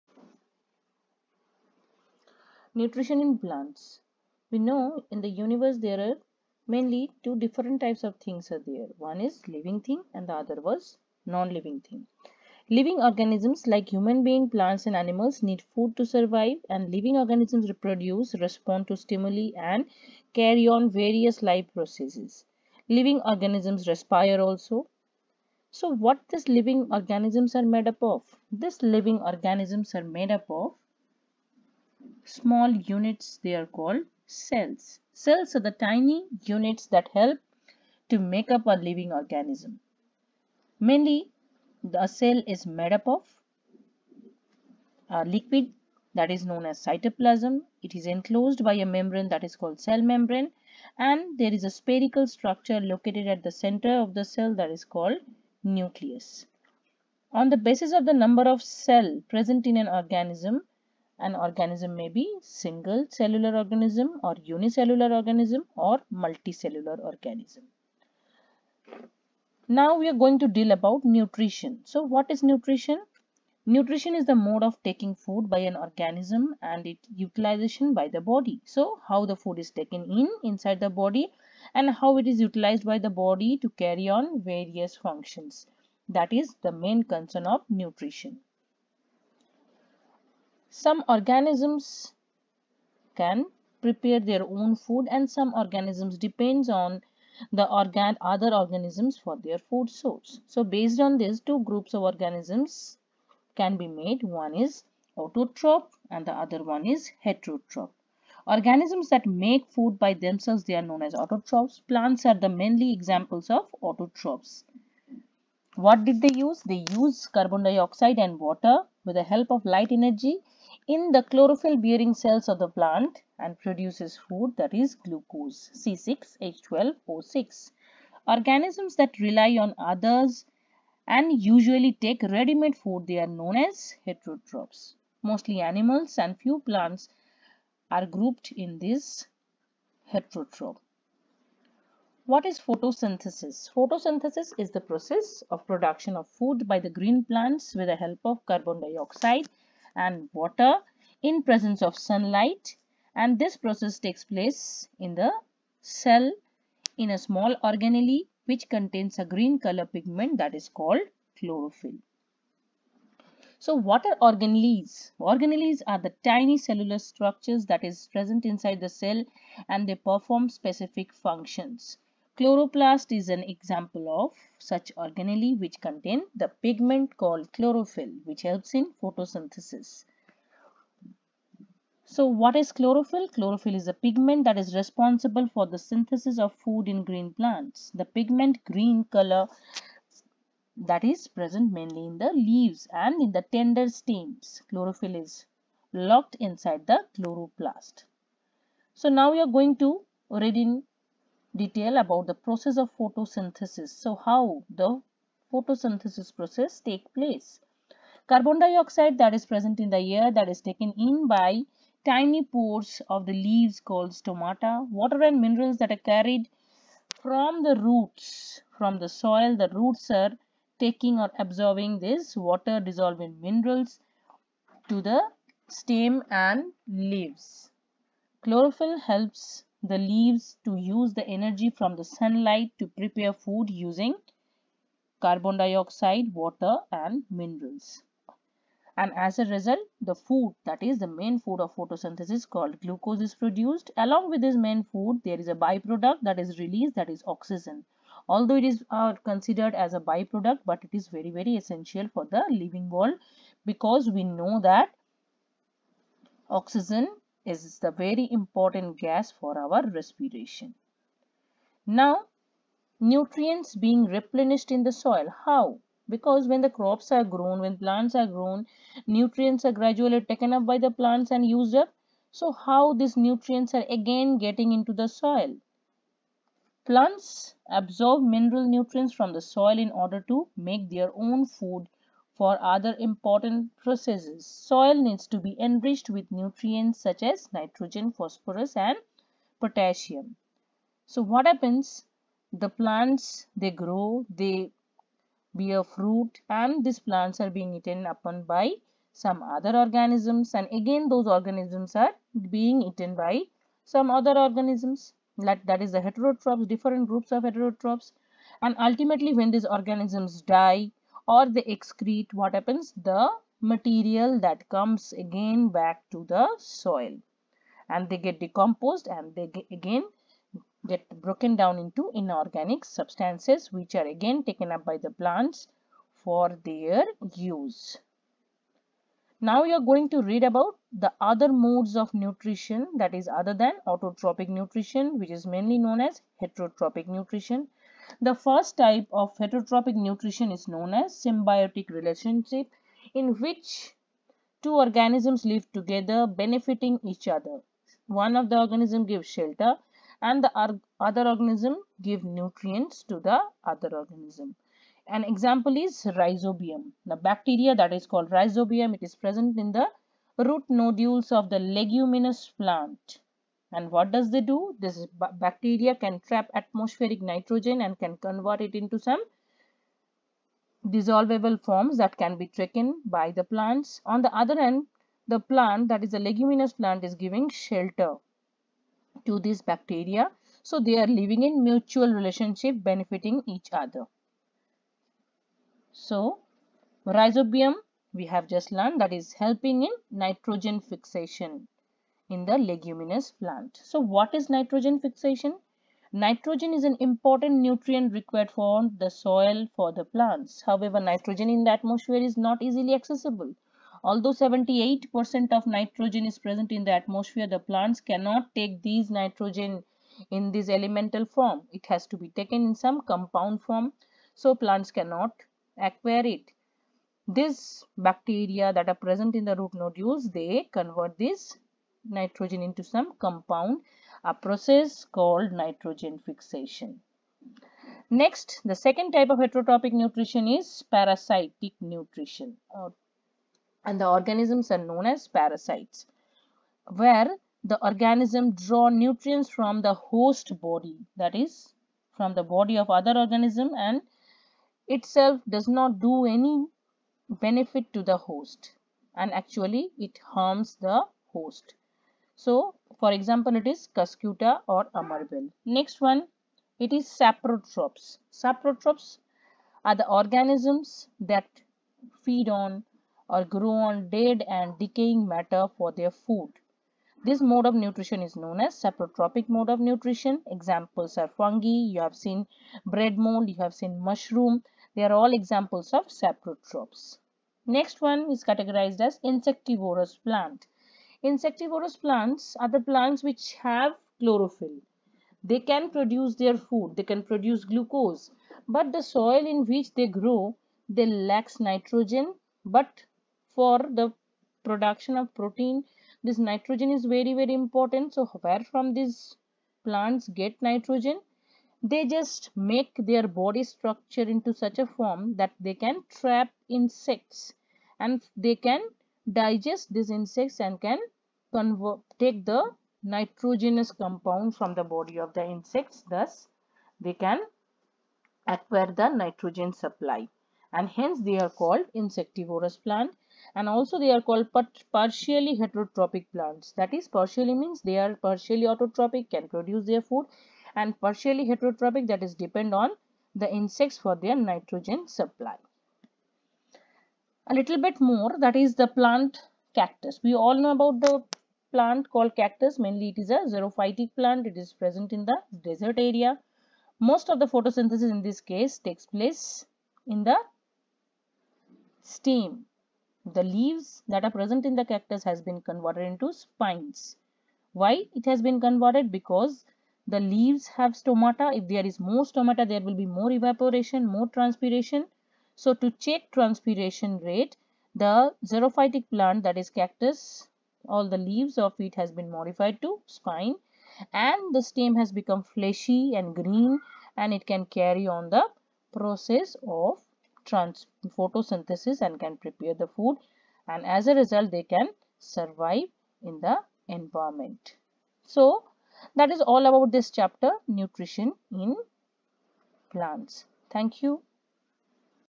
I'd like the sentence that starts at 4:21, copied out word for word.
Now, nutrients being replenished in the soil.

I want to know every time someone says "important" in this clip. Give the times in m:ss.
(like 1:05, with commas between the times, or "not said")
4:18, 4:42, 6:37, 8:17.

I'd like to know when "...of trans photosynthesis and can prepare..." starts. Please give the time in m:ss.
9:39.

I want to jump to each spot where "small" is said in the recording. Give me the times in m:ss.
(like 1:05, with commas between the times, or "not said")
0:32, 2:37.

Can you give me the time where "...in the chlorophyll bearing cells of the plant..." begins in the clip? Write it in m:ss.
2:00.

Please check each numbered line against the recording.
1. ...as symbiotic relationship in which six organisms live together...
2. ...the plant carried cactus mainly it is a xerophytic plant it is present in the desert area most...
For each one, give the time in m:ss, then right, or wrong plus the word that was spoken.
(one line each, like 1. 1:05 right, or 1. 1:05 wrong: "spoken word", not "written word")
1. 5:40 wrong: "two", not "six"
2. 9:00 wrong: "called", not "carried".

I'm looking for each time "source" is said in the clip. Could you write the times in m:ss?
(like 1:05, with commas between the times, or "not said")
1:39.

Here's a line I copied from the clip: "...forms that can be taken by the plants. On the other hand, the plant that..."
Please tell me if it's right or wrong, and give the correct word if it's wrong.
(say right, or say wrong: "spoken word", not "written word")
right.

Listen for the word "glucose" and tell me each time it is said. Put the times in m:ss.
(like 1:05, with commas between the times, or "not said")
2:04, 4:02, 8:07.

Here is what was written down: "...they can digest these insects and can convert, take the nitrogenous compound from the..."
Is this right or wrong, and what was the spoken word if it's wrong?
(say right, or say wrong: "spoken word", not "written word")
right.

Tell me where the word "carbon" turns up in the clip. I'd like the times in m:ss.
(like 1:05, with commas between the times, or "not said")
1:57, 2:28, 3:28, 3:55.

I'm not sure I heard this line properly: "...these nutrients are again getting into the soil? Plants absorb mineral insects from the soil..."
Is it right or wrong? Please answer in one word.
wrong.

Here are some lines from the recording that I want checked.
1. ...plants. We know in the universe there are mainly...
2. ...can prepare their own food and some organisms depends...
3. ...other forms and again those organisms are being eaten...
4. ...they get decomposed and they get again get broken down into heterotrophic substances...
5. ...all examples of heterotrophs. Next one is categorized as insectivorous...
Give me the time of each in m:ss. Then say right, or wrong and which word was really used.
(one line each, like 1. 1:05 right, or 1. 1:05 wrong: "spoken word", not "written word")
1. 0:03 right
2. 1:33 right
3. 4:59 wrong: "organisms", not "forms"
4. 5:18 wrong: "inorganic", not "heterotrophic"
5. 7:55 wrong: "saprotrophs", not "heterotrophs".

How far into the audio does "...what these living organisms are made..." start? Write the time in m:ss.
0:25.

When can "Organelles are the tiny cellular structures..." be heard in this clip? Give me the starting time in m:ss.
2:45.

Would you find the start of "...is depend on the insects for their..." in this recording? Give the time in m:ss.
8:52.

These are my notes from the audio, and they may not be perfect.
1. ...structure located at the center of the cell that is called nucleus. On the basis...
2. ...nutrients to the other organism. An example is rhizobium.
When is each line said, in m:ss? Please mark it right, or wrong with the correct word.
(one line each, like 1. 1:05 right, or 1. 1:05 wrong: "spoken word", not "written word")
1. 0:52 right
2. 5:52 right.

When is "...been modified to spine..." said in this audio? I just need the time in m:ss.
9:32.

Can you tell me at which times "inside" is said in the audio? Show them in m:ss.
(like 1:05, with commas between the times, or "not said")
1:20, 2:48, 3:16.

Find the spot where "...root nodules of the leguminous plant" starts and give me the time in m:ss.
6:00.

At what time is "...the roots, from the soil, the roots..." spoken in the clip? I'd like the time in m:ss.
3:37.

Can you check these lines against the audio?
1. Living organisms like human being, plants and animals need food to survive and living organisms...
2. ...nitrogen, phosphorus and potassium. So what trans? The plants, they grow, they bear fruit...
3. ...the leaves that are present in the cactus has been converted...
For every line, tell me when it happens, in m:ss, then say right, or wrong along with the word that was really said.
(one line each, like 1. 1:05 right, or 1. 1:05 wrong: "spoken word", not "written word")
1. 0:12 right
2. 4:47 wrong: "happens", not "trans"
3. 9:13 right.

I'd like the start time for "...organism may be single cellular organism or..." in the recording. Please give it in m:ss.
1:01.